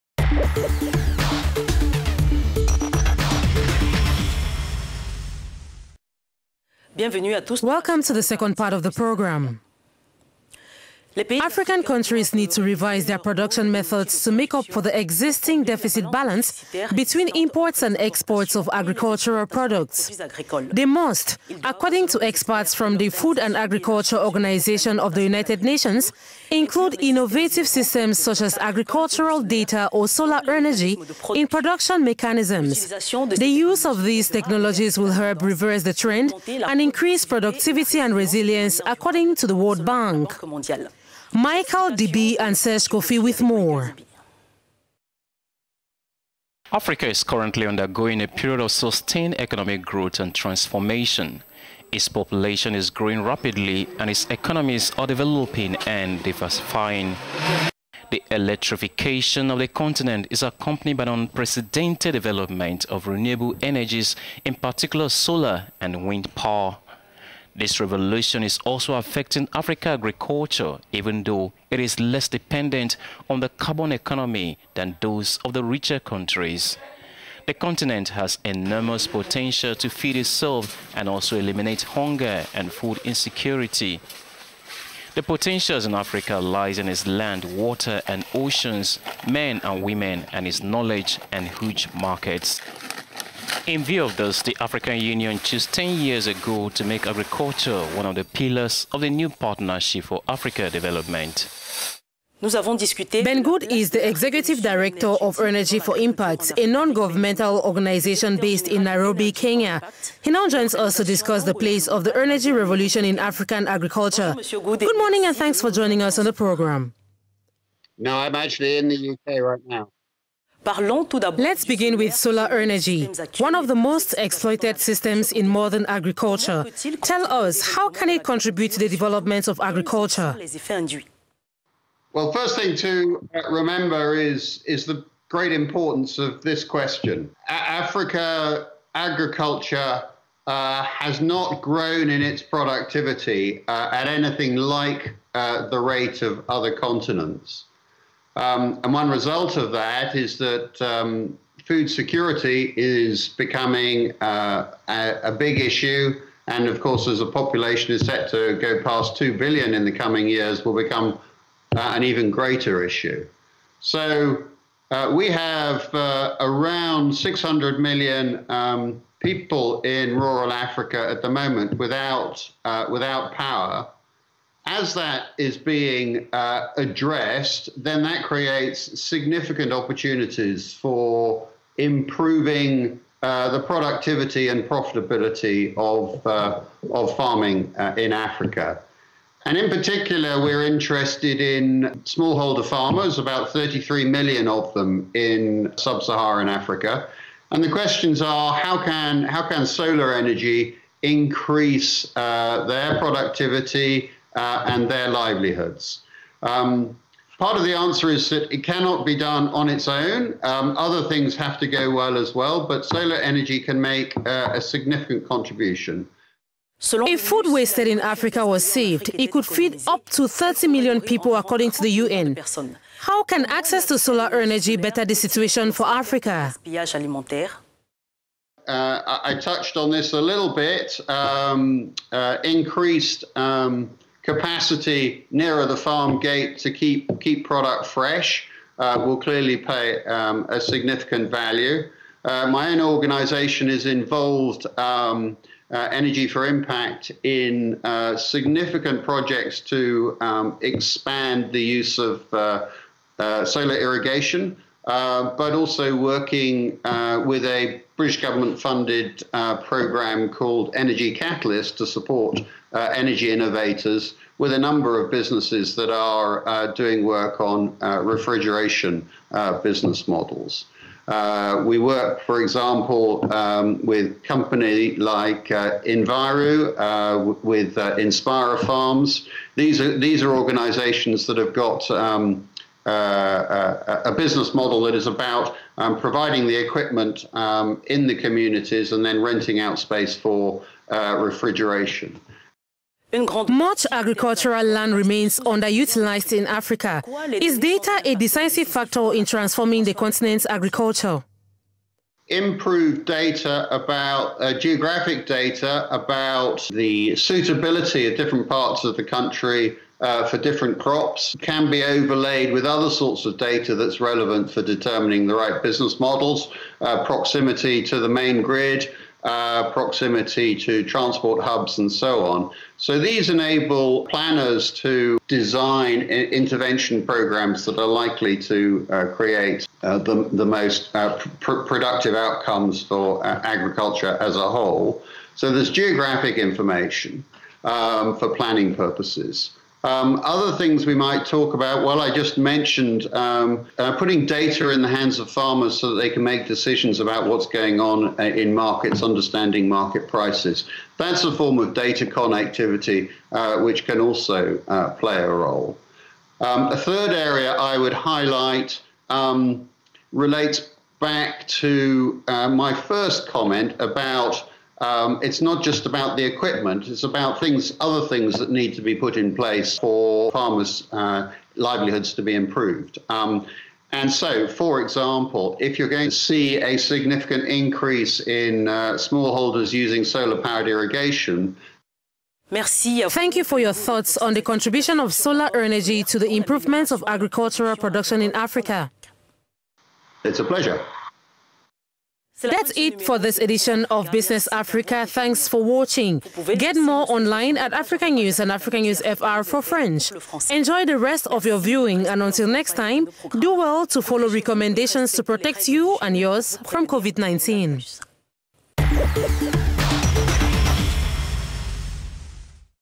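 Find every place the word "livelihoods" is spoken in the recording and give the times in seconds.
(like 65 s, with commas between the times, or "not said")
205 s, 371 s.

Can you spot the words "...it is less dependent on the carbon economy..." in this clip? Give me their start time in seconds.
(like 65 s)
71 s.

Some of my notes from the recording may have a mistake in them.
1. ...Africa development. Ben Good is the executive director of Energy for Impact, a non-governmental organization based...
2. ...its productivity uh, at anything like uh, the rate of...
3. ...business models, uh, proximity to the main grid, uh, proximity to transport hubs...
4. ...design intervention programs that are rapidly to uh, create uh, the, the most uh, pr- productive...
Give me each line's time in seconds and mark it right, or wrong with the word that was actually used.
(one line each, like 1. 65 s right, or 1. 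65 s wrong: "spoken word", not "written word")
1. 100 s right
2. 142 s right
3. 315 s right
4. 325 s wrong: "likely", not "rapidly".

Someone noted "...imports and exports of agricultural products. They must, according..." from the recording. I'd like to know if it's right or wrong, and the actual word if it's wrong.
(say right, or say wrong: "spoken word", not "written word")
right.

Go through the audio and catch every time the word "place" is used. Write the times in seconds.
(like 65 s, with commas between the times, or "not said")
111 s, 369 s.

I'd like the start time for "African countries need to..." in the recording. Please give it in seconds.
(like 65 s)
11 s.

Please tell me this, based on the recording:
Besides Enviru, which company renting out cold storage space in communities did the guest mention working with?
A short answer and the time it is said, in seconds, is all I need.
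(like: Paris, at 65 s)
Inspira Farms, at 277 s.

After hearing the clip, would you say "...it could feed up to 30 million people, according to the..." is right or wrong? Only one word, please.
right.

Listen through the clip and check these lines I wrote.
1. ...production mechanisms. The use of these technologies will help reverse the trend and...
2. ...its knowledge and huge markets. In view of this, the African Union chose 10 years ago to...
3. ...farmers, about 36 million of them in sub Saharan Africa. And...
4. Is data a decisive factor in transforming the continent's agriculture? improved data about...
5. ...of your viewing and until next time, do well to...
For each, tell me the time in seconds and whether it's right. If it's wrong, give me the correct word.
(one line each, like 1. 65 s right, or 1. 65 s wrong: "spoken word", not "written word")
1. 31 s right
2. 90 s right
3. 192 s wrong: "33", not "36"
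4. 297 s right
5. 401 s right.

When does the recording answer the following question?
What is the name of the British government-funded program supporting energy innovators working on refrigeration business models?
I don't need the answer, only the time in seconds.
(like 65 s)
260 s.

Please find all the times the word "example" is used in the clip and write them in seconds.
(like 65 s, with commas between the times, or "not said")
272 s, 374 s.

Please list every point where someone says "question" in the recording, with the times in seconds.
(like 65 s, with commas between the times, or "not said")
136 s, 197 s.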